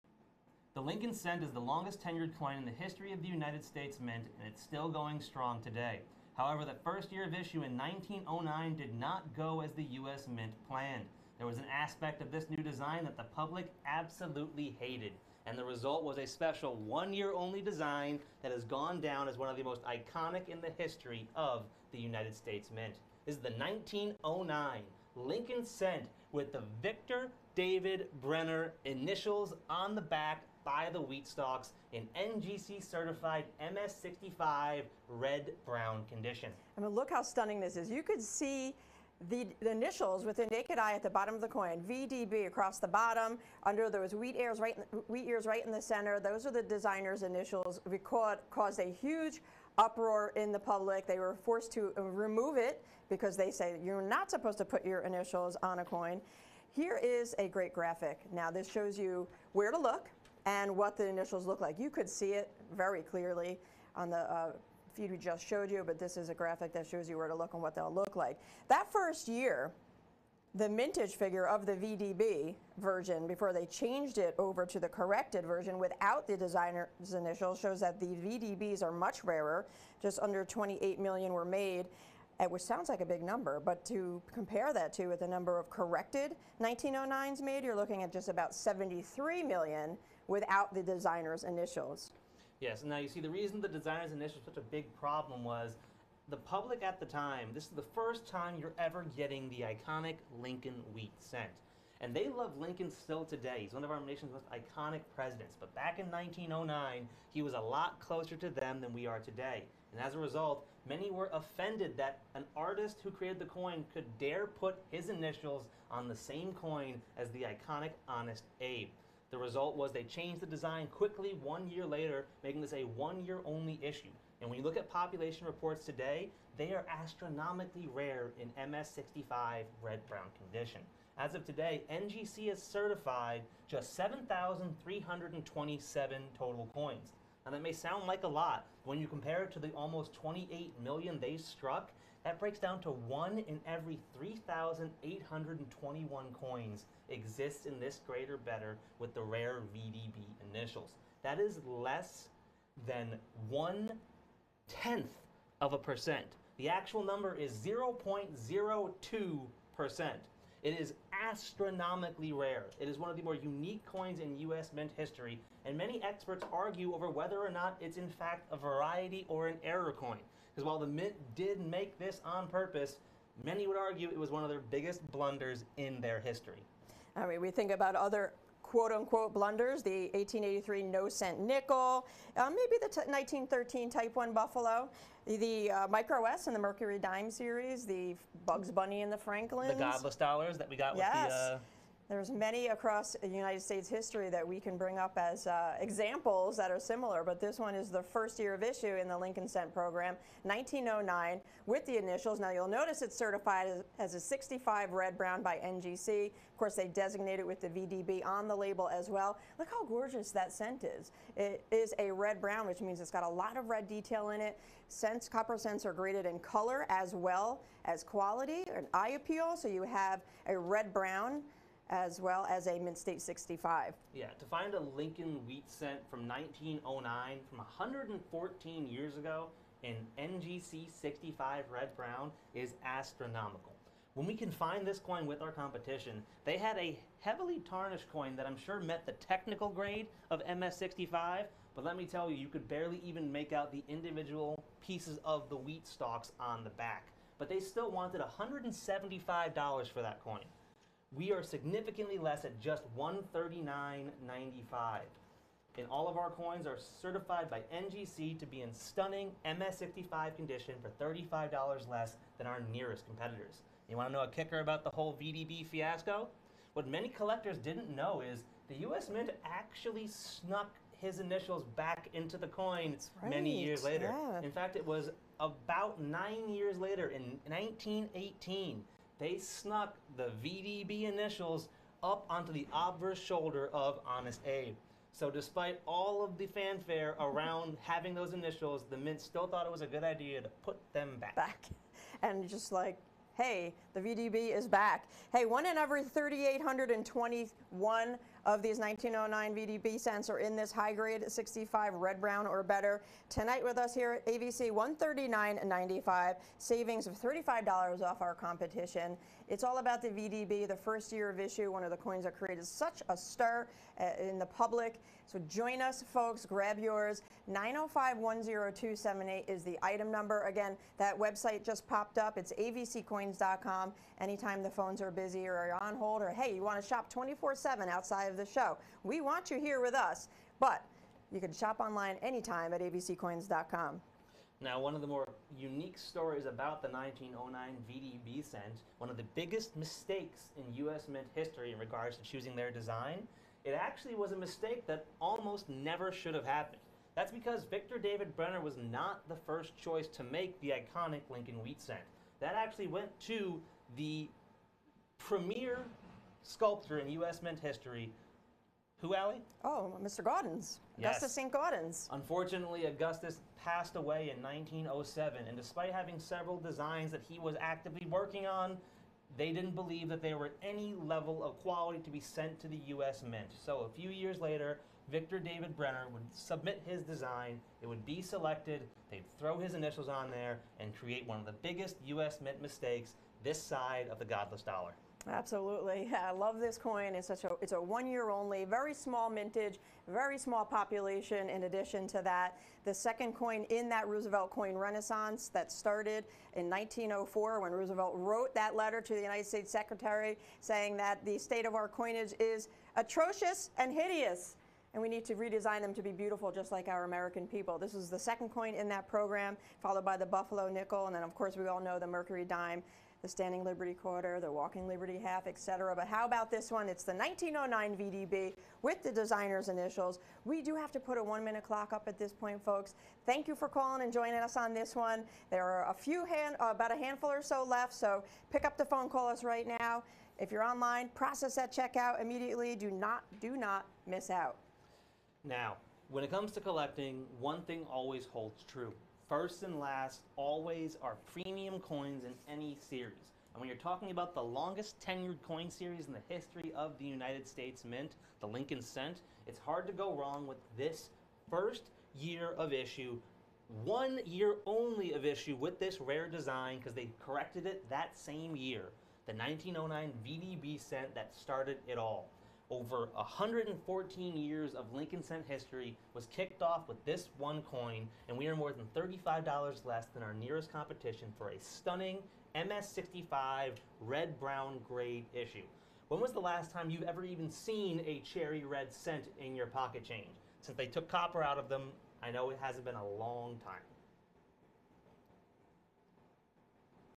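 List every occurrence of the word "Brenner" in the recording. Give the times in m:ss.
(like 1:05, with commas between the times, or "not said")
0:28, 5:48, 6:15.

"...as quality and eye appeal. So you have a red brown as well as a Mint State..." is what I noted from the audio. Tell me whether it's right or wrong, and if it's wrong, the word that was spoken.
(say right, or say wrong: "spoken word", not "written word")
right.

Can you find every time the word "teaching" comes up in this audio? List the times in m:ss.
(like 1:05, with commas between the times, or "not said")
not said.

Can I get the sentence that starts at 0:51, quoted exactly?
They were forced to uh, remove it because they say you're not supposed to put your initials on a coin.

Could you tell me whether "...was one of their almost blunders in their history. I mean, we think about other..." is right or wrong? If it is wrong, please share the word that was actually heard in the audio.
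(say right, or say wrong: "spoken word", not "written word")
wrong: "biggest", not "almost".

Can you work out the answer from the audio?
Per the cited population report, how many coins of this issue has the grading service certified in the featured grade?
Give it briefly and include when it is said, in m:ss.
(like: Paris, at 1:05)
7,327, at 2:13.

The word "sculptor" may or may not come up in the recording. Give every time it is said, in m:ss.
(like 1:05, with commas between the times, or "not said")
5:56.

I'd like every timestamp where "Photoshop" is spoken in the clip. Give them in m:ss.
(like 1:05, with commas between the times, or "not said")
not said.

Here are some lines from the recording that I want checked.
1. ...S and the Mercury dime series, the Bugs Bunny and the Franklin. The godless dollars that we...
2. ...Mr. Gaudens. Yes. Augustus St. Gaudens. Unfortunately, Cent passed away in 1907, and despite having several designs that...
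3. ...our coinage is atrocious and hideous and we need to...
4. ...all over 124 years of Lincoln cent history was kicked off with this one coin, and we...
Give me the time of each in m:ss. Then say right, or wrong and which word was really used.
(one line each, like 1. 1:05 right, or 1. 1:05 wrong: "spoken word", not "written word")
1. 3:06 right
2. 6:00 wrong: "Augustus", not "Cent"
3. 6:41 right
4. 7:41 wrong: "114", not "124".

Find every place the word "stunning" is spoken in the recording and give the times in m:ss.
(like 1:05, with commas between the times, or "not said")
0:37, 4:18, 7:51.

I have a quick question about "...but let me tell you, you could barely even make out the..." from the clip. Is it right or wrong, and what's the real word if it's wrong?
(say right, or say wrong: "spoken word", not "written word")
right.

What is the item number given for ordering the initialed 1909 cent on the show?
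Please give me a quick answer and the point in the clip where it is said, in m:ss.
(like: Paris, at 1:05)
905-10278, at 5:17.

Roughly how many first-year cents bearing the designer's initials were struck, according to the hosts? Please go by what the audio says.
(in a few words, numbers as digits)
Just under 28 million.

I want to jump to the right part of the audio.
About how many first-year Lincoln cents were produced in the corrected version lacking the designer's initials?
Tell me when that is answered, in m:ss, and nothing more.
1:28.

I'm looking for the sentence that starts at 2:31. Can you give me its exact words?
That is less than one tenth of a percent.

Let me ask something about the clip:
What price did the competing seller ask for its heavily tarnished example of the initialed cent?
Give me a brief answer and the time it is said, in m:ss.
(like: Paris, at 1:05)
$175, at 4:08.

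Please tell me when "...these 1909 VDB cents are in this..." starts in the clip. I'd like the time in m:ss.
4:58.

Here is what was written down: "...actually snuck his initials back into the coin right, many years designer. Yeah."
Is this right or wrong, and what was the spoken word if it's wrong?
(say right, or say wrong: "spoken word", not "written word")
wrong: "later", not "designer".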